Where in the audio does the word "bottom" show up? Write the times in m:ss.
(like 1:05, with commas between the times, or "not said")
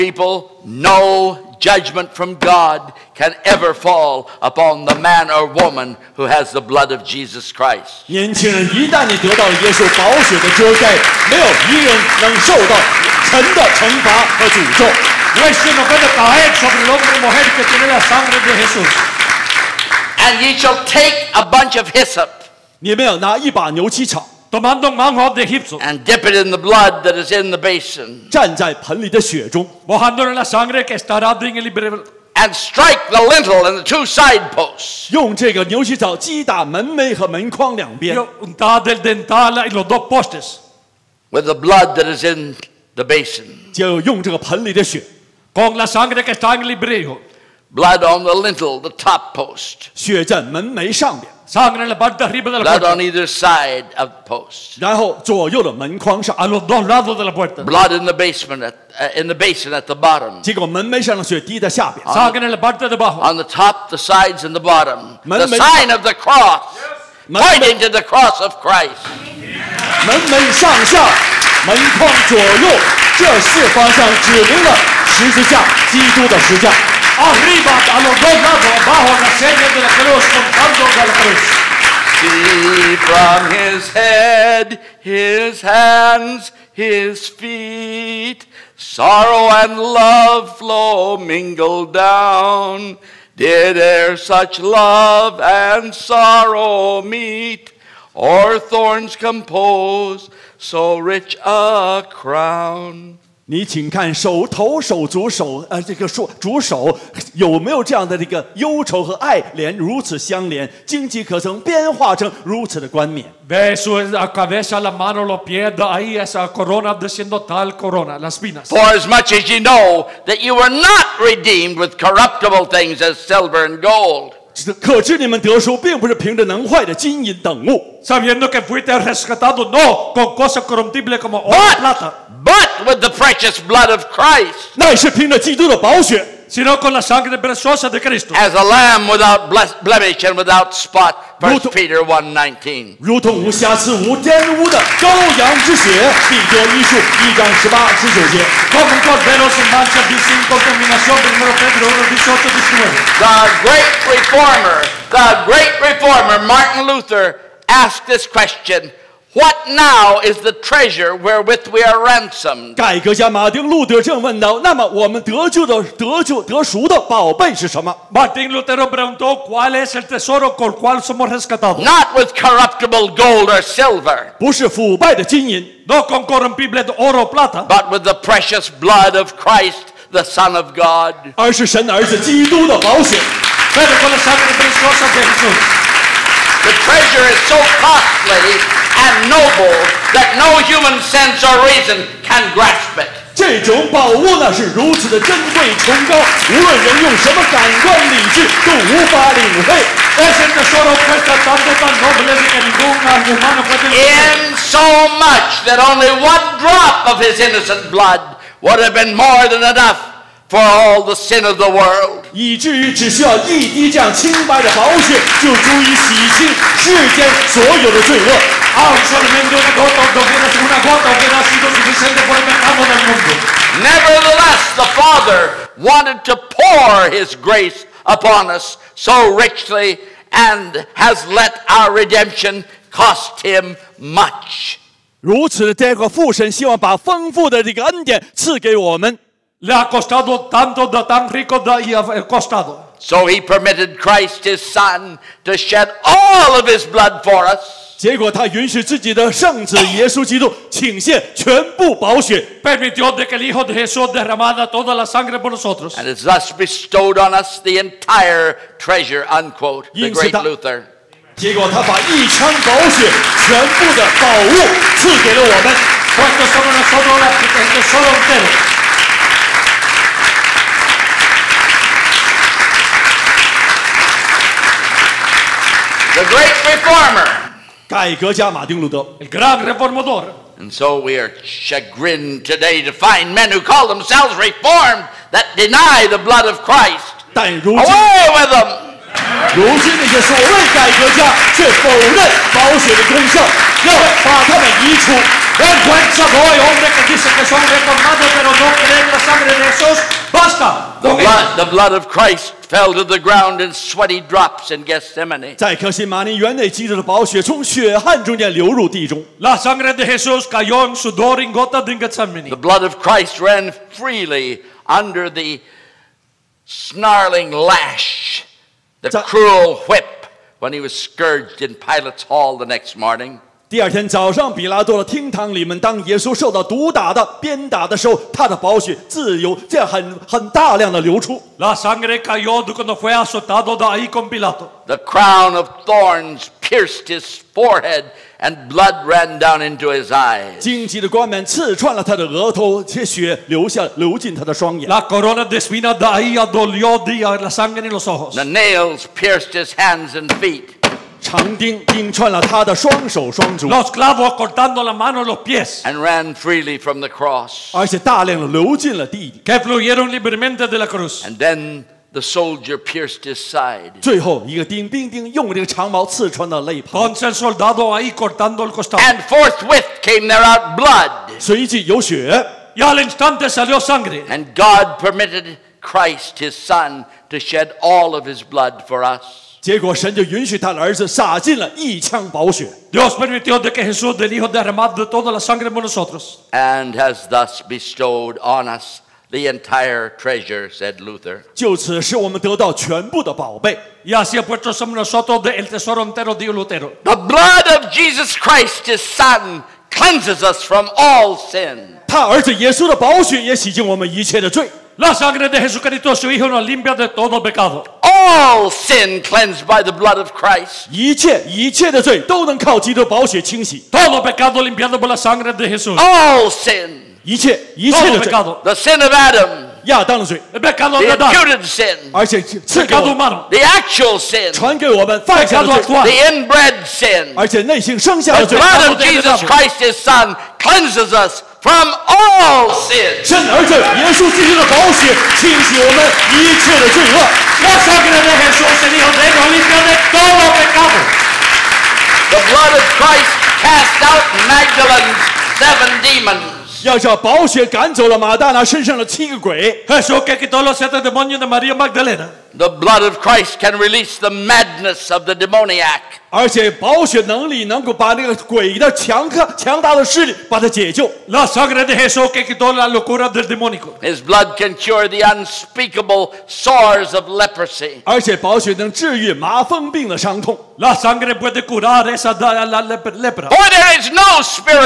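0:59, 1:04.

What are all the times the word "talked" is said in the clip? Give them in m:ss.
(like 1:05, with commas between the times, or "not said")
not said.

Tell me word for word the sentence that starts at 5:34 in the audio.
The crown of thorns pierced his forehead, and blood ran down into his eyes.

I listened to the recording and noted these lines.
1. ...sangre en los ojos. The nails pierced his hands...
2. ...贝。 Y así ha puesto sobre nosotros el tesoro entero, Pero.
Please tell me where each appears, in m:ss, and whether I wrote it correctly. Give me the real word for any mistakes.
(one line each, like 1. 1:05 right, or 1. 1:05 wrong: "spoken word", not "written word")
1. 5:47 right
2. 6:33 wrong: "Lutero", not "Pero".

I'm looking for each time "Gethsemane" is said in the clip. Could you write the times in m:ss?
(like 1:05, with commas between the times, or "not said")
5:04, 5:11.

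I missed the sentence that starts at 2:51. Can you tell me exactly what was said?
Not with corruptible gold or silver.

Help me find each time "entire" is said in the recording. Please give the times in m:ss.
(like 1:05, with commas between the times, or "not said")
4:17, 6:29.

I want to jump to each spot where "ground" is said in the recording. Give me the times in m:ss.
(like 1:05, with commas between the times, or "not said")
5:03.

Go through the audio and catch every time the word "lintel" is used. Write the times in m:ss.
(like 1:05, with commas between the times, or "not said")
0:33, 0:48.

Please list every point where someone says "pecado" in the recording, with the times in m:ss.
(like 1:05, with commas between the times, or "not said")
3:42, 6:47, 6:54.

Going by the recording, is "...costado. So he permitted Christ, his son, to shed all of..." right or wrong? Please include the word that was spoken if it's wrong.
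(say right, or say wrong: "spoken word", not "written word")
right.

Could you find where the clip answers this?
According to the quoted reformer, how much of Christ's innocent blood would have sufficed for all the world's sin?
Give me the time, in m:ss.
3:26.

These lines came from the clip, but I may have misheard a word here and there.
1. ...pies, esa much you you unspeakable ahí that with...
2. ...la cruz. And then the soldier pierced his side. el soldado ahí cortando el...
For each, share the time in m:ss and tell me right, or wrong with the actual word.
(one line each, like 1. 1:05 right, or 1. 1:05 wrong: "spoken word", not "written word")
1. 1:58 wrong: "corruptible", not "unspeakable"
2. 6:00 right.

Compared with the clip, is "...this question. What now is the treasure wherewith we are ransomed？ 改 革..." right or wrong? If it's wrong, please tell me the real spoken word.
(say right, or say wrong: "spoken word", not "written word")
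right.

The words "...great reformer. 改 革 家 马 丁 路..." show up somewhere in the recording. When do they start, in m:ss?
4:36.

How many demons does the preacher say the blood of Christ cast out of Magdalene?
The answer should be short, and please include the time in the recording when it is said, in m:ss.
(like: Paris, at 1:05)
7, at 7:25.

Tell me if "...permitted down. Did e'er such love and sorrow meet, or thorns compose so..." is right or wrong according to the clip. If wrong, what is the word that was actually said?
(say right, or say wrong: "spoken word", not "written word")
wrong: "mingled", not "permitted".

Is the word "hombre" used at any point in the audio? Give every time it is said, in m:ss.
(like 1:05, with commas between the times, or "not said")
4:49.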